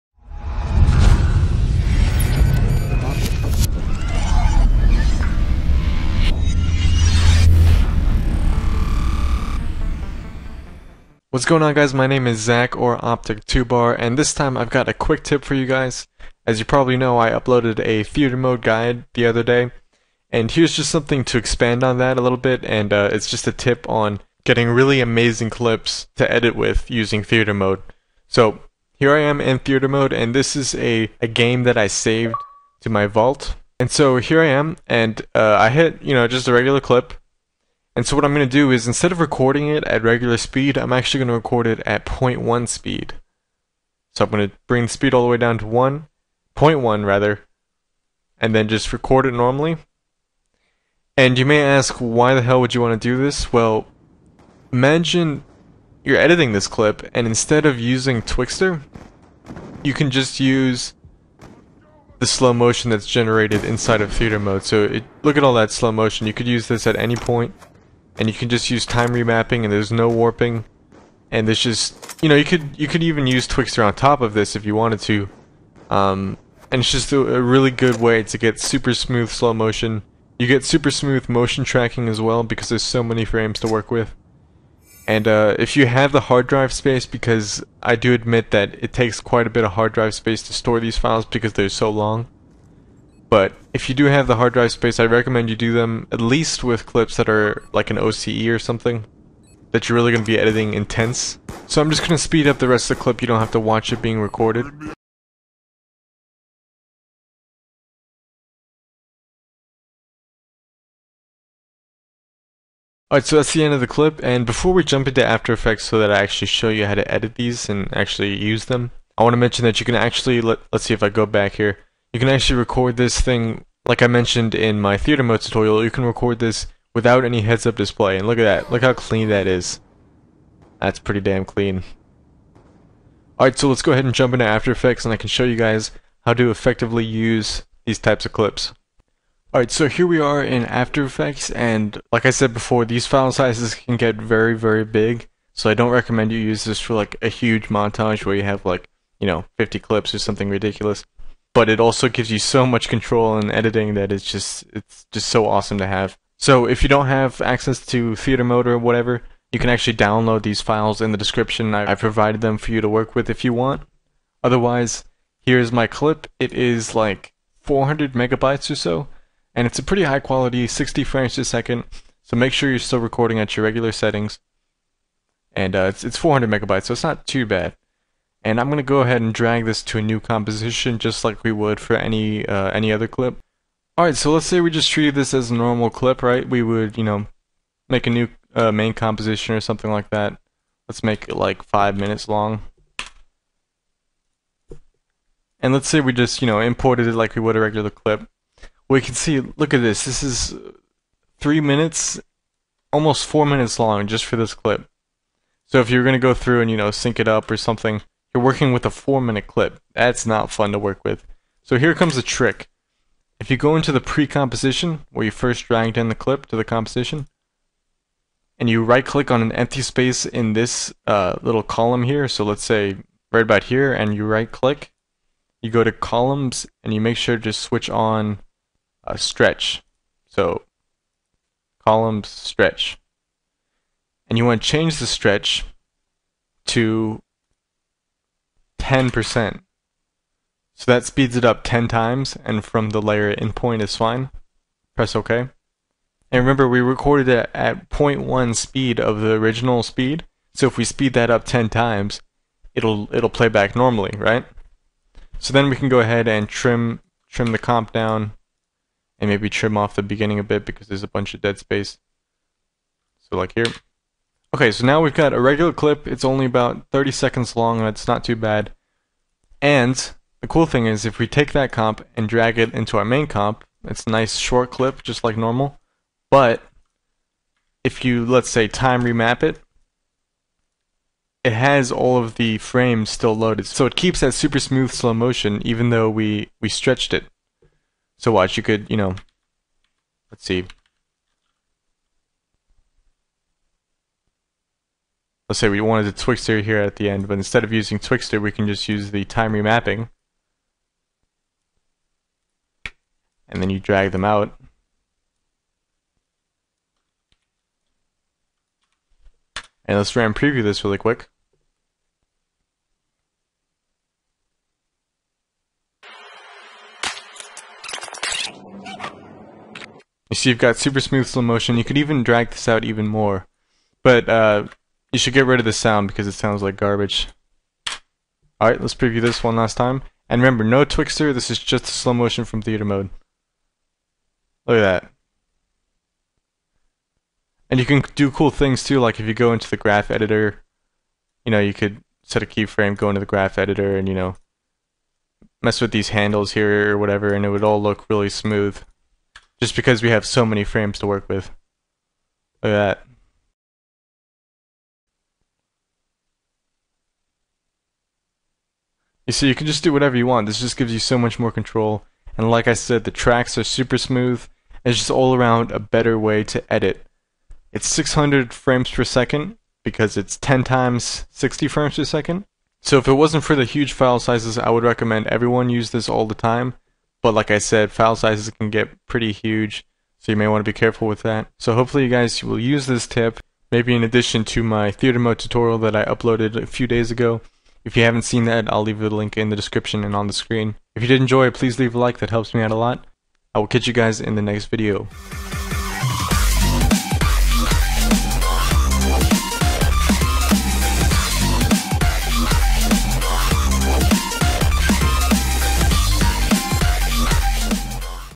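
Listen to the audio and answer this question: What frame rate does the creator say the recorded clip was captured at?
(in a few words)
60 frames a second.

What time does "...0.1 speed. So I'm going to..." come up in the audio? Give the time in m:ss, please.
0:42.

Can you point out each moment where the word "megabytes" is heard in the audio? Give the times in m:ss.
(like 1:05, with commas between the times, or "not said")
2:48, 2:56.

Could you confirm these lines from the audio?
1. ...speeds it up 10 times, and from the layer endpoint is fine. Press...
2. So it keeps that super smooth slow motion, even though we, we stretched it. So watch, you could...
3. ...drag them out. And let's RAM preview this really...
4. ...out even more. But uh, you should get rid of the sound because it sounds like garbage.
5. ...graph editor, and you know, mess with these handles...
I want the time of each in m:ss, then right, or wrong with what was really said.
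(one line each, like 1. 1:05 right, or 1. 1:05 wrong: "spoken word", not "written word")
1. 4:01 right
2. 4:43 right
3. 5:03 right
4. 5:22 right
5. 5:43 right.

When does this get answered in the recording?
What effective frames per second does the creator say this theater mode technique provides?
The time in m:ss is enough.
6:07.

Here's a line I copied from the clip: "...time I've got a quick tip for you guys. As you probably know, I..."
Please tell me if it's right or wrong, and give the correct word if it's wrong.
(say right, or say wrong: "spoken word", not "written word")
right.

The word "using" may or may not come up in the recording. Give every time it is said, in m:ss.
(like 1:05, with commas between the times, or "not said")
0:26, 0:57, 4:57.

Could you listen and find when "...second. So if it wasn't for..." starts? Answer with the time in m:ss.
6:12.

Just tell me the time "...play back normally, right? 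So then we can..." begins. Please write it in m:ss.
4:13.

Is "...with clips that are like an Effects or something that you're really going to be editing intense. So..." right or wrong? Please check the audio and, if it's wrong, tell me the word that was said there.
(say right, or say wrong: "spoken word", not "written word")
wrong: "OCE", not "Effects".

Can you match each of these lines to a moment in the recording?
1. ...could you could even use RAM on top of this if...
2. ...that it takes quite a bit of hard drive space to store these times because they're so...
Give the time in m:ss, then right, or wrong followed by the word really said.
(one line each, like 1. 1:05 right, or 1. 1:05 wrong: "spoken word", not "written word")
1. 1:12 wrong: "Twixtor", not "RAM"
2. 1:28 wrong: "files", not "times".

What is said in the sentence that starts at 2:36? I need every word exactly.
So if you don't have access to theater mode or whatever, you can actually download these files in the description.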